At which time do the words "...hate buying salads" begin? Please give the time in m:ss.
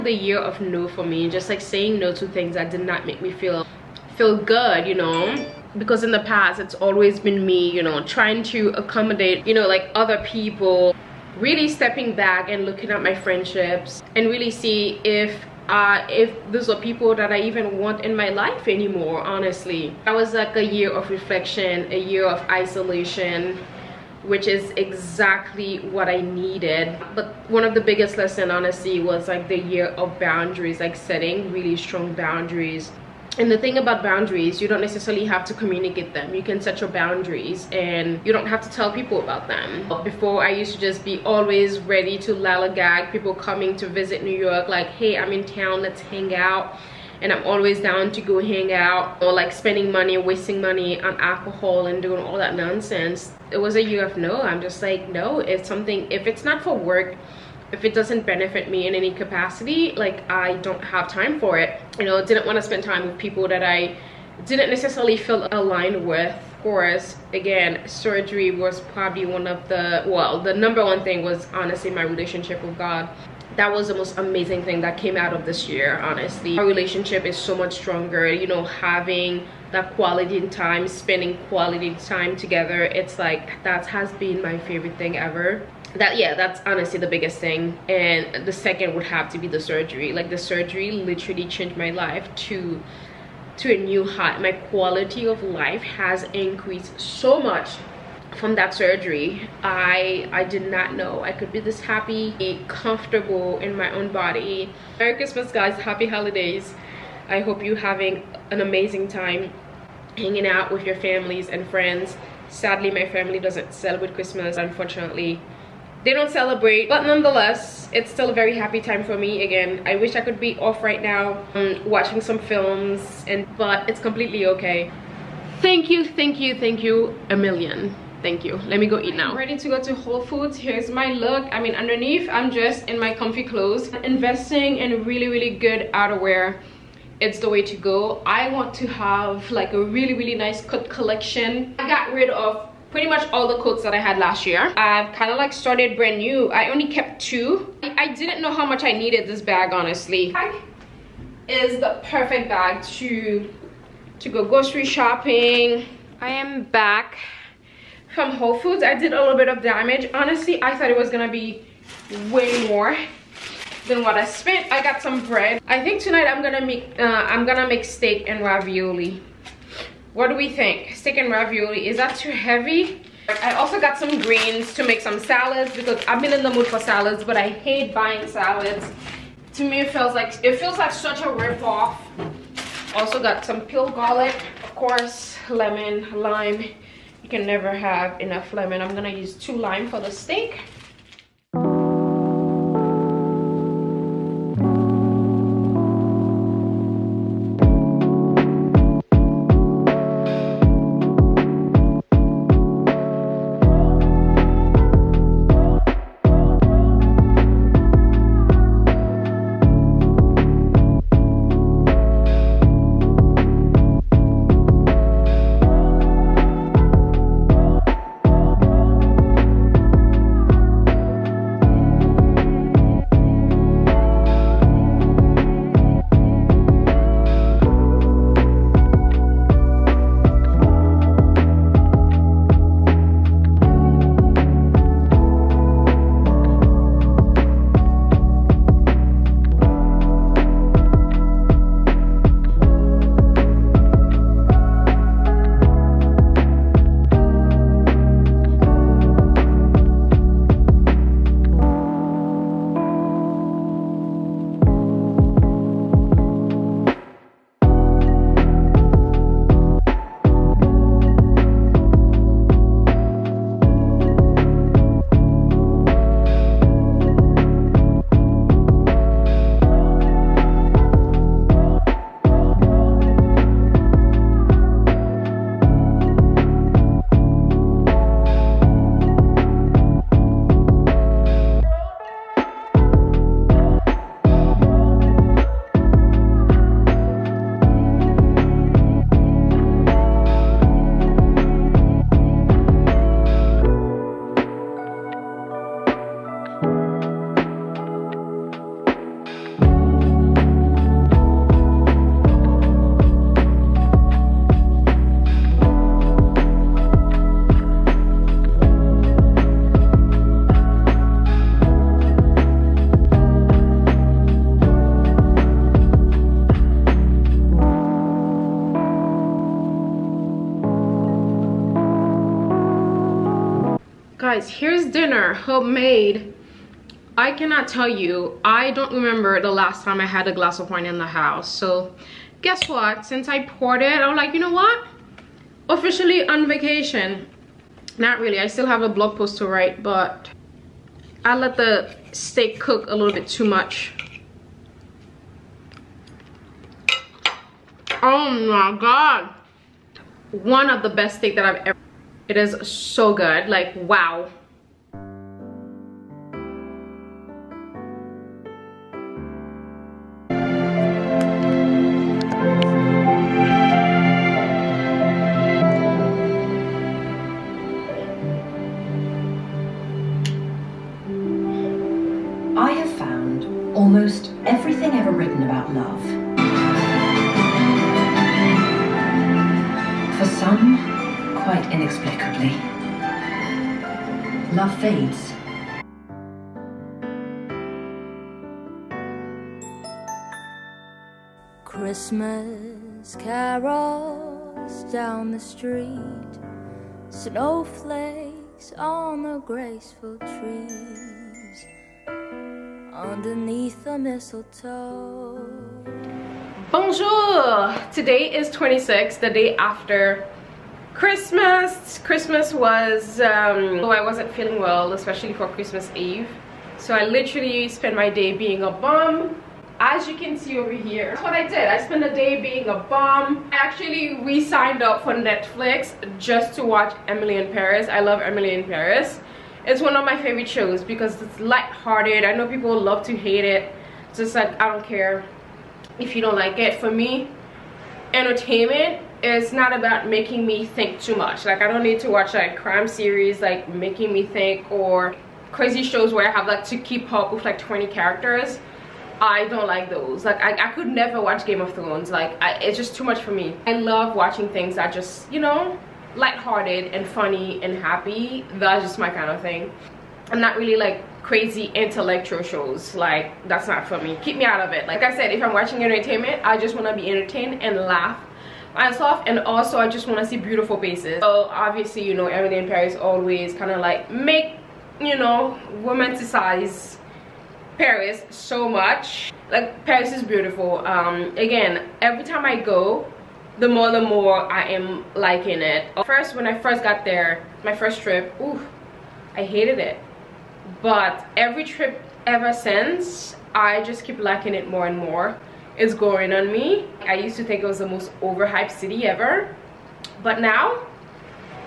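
2:57.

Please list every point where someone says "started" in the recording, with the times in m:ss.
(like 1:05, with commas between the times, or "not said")
2:25.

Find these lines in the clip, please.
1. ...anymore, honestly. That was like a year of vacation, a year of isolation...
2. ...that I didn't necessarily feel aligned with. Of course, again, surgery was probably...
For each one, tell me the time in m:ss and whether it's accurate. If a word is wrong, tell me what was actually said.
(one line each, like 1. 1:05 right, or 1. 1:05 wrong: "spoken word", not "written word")
1. 0:18 wrong: "reflection", not "vacation"
2. 1:03 right.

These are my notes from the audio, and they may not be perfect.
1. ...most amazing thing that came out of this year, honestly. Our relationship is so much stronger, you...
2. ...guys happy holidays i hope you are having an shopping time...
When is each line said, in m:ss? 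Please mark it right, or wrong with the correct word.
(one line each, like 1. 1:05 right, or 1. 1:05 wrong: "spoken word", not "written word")
1. 1:13 right
2. 1:45 wrong: "amazing", not "shopping".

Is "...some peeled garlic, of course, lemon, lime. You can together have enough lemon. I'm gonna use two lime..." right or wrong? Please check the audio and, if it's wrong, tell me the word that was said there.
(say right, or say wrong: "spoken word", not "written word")
wrong: "never", not "together".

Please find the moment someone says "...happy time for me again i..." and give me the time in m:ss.
1:58.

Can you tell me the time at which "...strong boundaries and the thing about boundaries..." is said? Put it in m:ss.
0:31.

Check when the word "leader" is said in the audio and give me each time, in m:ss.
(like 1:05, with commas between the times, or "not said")
not said.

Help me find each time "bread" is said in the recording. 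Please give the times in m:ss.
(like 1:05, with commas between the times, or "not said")
2:45.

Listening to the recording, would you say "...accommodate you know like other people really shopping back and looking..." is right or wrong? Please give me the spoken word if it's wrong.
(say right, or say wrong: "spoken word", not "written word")
wrong: "stepping", not "shopping".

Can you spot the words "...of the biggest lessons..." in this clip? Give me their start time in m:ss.
0:27.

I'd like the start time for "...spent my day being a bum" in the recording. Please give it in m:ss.
6:57.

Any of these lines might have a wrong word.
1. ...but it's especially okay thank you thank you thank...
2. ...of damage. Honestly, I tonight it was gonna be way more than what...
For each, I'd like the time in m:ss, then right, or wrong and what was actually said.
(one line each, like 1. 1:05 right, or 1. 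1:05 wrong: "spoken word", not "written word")
1. 2:03 wrong: "completely", not "especially"
2. 2:39 wrong: "thought", not "tonight".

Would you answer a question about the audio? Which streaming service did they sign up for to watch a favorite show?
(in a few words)
Netflix.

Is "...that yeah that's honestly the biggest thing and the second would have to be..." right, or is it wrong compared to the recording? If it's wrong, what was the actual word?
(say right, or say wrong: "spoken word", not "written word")
right.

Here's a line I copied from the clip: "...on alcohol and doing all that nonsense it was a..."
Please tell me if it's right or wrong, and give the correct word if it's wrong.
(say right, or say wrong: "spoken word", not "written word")
right.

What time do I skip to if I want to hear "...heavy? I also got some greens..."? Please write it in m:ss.
2:52.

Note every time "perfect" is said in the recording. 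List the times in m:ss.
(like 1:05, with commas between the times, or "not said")
2:32.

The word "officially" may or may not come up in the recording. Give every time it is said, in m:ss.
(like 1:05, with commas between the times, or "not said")
5:35.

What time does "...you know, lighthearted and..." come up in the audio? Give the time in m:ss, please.
7:35.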